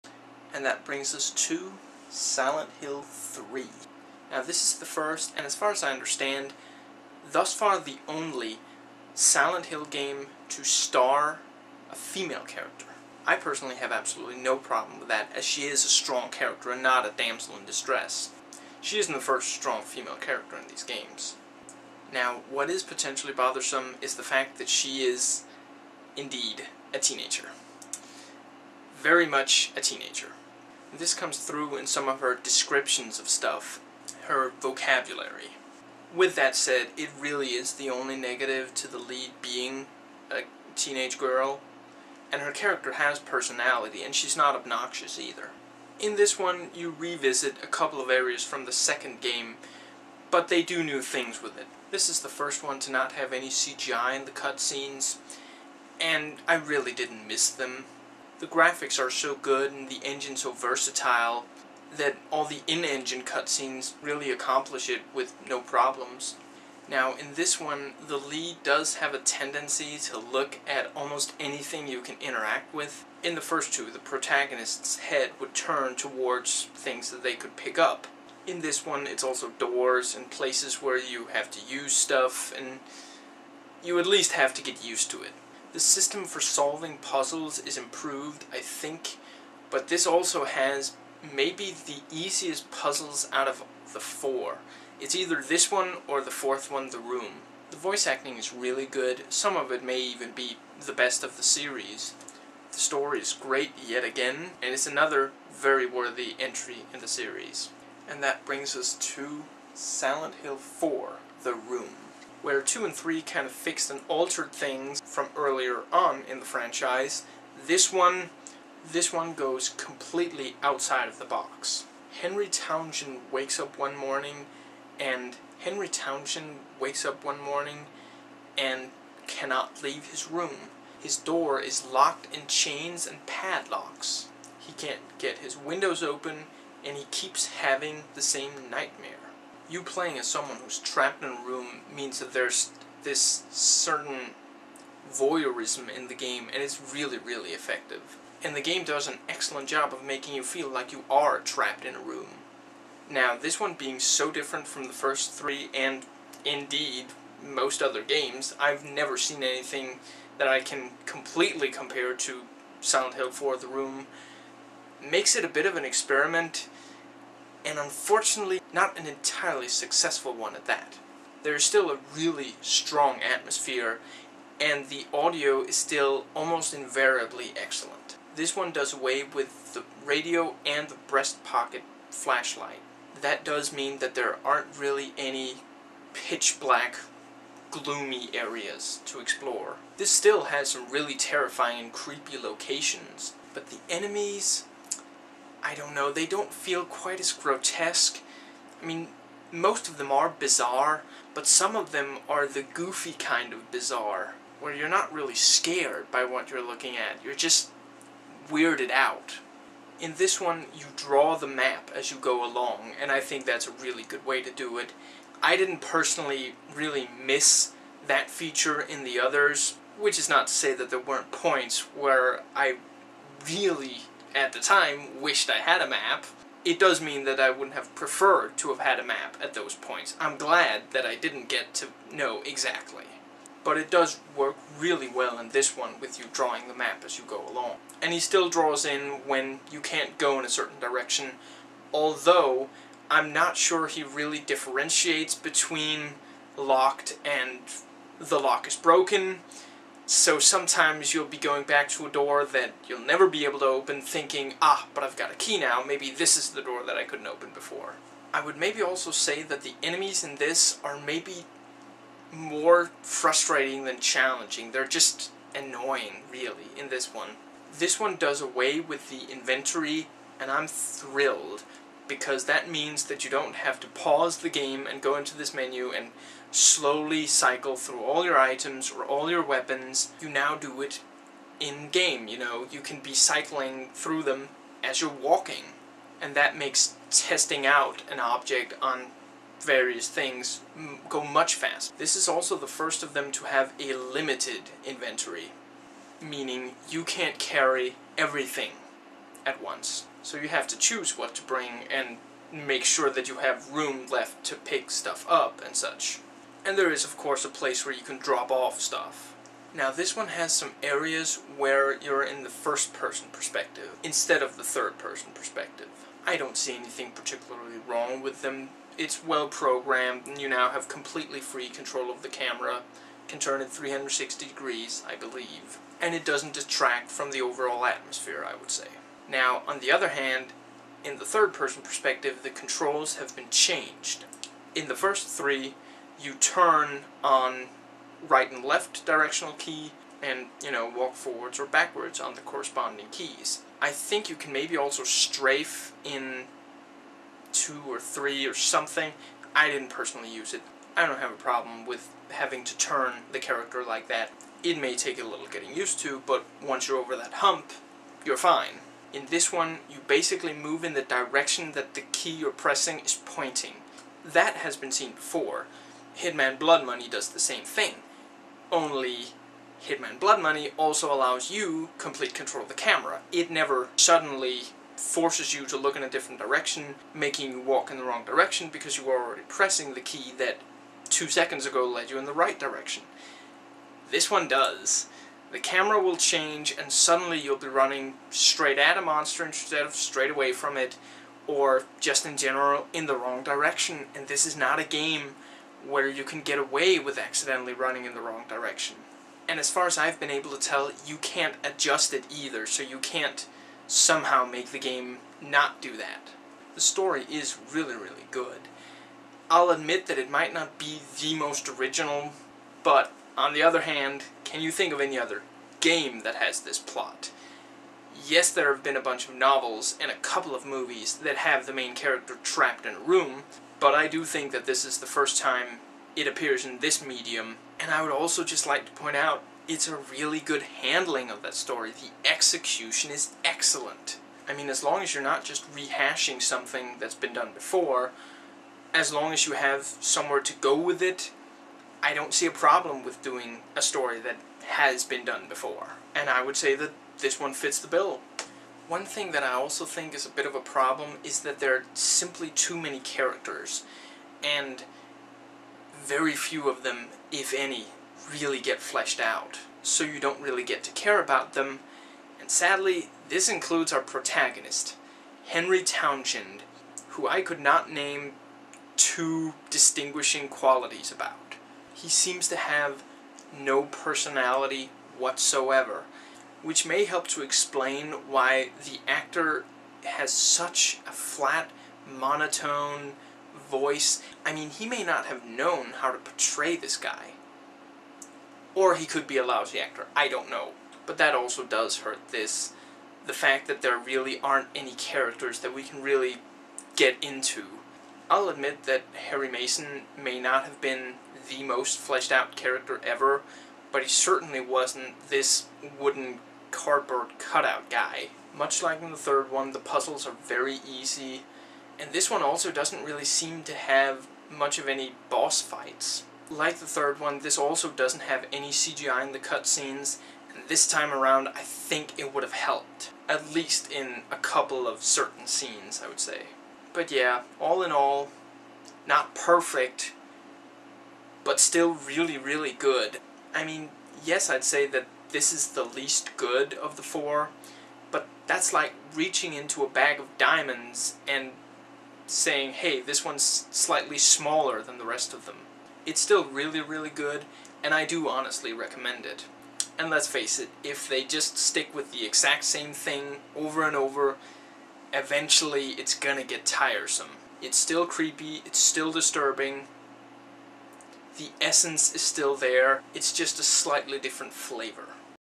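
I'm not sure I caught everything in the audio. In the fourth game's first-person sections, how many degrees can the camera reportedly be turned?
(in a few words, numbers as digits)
360.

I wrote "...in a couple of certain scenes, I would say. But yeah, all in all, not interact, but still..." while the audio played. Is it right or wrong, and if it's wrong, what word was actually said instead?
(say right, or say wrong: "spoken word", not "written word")
wrong: "perfect", not "interact".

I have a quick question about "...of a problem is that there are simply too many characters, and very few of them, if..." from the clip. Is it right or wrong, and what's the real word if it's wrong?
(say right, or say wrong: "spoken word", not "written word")
right.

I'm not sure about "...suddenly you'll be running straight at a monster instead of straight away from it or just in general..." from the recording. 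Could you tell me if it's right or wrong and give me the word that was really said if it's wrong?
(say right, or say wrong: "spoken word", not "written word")
right.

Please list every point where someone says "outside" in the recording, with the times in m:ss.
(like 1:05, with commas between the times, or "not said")
2:00.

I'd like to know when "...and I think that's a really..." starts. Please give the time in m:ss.
3:32.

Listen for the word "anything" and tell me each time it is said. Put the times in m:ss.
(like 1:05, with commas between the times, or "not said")
1:11, 2:39, 5:16.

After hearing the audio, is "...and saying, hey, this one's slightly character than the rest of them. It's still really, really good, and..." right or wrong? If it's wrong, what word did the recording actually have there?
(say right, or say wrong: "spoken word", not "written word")
wrong: "smaller", not "character".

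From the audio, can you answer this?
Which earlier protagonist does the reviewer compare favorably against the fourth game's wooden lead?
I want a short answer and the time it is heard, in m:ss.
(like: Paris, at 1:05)
Harry Mason, at 8:19.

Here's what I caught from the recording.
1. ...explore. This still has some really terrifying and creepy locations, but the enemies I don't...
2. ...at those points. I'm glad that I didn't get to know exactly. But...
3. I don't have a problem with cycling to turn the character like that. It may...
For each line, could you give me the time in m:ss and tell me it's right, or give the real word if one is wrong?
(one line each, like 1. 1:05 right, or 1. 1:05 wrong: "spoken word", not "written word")
1. 3:09 right
2. 3:49 right
3. 5:50 wrong: "having", not "cycling".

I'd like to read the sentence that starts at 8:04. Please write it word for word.
I mean, he may not have known how to portray this guy.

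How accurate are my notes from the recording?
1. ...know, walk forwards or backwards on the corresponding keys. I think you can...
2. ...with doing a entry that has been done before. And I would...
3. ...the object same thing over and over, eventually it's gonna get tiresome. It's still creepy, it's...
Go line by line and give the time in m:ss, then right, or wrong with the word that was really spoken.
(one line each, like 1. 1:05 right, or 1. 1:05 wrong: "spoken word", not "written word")
1. 5:40 right
2. 7:23 wrong: "story", not "entry"
3. 9:12 wrong: "exact", not "object".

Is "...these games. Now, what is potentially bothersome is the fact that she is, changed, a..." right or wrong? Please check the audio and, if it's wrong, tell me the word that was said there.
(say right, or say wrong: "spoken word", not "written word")
wrong: "indeed", not "changed".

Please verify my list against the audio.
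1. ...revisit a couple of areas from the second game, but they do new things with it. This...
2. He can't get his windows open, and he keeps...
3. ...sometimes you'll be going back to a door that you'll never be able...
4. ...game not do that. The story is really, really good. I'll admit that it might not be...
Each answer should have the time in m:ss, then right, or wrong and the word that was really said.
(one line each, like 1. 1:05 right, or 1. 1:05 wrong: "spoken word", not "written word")
1. 0:46 right
2. 2:14 right
3. 4:10 right
4. 6:44 right.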